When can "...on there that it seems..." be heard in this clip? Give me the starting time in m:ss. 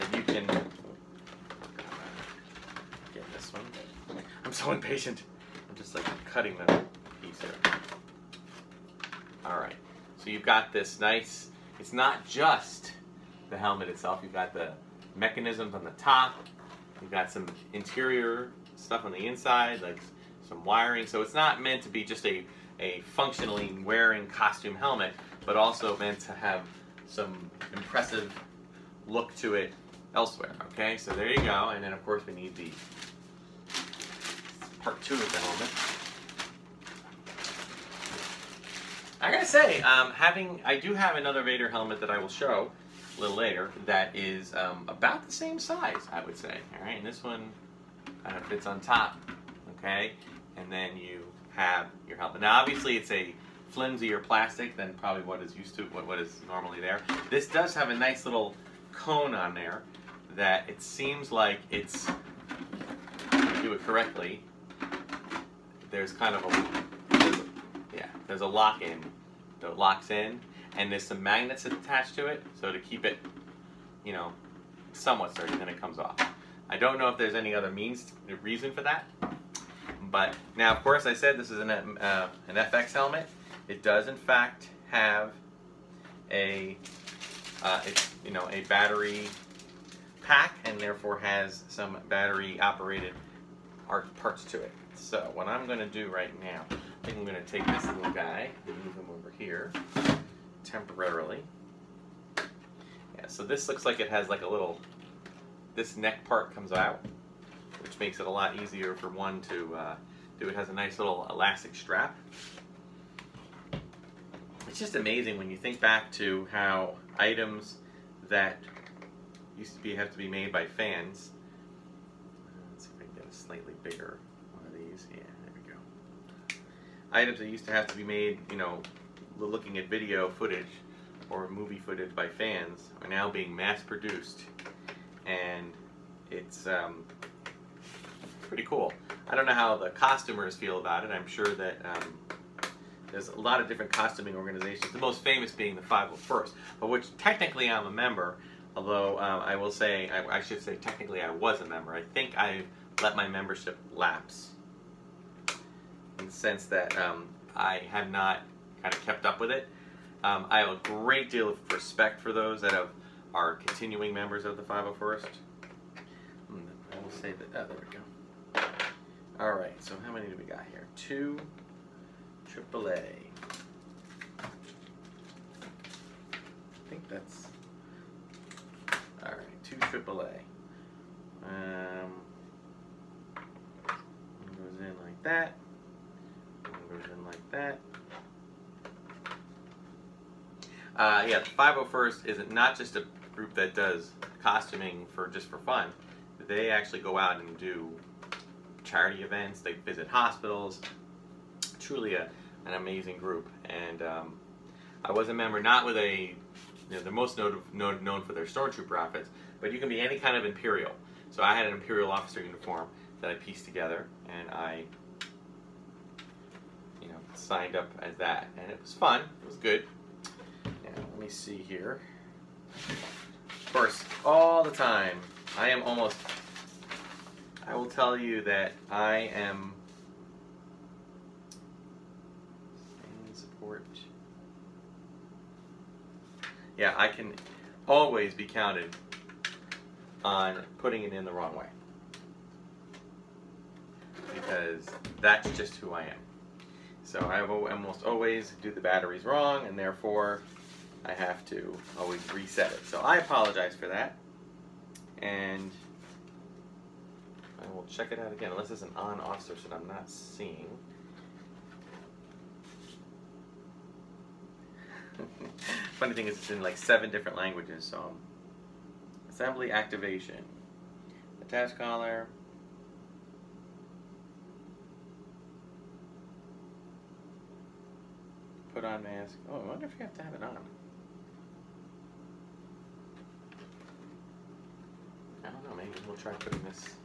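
0:59.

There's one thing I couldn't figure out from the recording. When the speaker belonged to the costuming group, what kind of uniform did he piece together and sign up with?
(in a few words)
Imperial officer uniform.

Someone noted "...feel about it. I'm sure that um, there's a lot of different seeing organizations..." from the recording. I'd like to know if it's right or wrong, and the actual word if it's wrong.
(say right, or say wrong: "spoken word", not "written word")
wrong: "costuming", not "seeing".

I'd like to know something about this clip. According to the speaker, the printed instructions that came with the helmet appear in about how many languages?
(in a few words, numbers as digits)
7.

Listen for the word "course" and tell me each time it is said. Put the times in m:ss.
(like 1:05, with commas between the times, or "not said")
0:32, 1:20.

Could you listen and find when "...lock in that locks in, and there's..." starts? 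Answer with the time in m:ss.
1:08.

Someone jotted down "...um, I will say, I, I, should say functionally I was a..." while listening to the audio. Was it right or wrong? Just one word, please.
wrong.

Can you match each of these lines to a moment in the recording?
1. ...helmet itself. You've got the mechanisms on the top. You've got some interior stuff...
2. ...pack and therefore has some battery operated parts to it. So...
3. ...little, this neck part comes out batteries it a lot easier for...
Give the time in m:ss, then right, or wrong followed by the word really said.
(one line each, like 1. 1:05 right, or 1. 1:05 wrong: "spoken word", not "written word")
1. 0:13 right
2. 1:30 right
3. 1:44 wrong: "makes", not "batteries".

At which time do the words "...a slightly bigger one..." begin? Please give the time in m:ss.
2:03.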